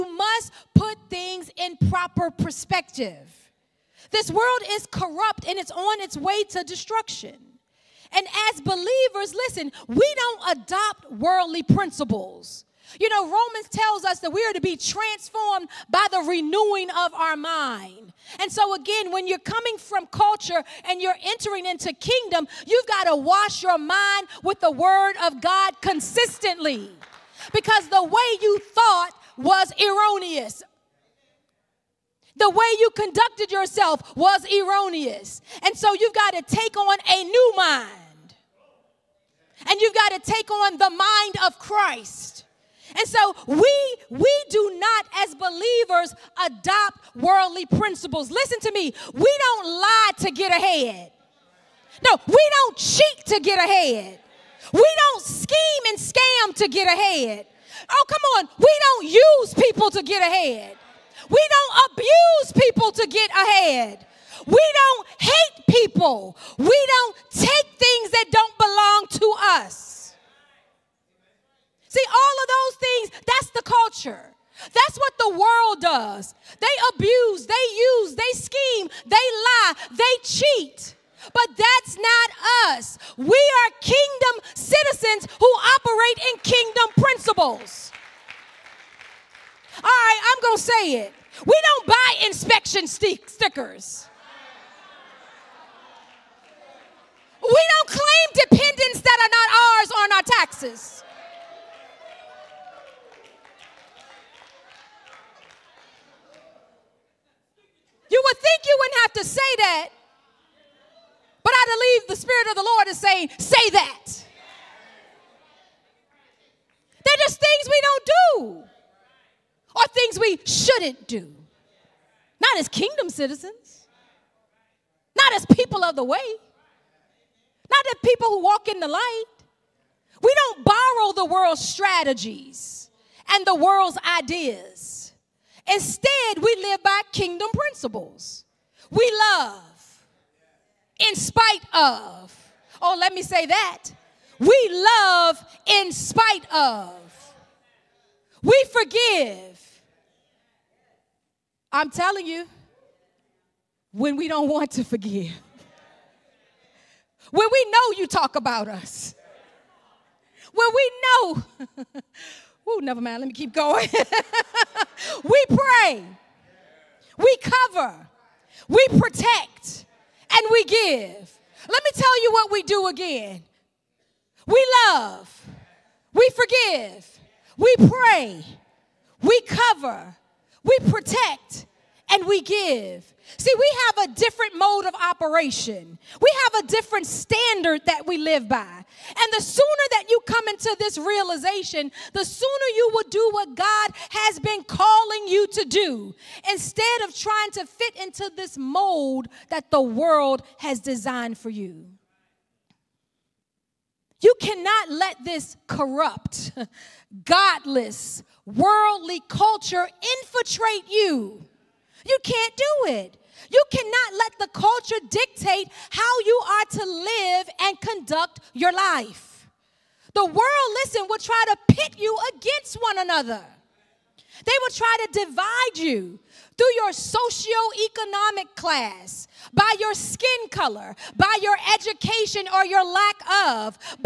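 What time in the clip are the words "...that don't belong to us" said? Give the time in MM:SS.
01:08.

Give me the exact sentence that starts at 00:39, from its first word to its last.
And you've got to take on the mind of Christ.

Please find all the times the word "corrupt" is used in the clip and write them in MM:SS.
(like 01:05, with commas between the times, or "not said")
00:04, 03:25.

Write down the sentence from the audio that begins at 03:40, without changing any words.
The world, listen, will try to pit you against one another.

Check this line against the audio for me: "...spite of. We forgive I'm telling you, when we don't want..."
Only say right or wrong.
right.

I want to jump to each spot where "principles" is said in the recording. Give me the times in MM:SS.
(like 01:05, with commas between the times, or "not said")
00:11, 00:47, 01:26, 02:17.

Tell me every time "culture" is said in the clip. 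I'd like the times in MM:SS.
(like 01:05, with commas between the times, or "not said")
00:20, 01:13, 03:29, 03:34.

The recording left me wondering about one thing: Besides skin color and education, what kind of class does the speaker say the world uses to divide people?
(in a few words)
socioeconomic class.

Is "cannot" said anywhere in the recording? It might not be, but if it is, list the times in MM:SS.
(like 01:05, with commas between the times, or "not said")
03:24, 03:33.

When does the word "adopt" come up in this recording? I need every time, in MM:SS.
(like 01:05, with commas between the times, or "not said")
00:10, 00:46.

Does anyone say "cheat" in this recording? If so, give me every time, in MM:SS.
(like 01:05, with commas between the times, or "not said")
00:52, 01:20.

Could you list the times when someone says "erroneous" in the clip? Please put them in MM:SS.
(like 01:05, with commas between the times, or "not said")
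00:29, 00:34.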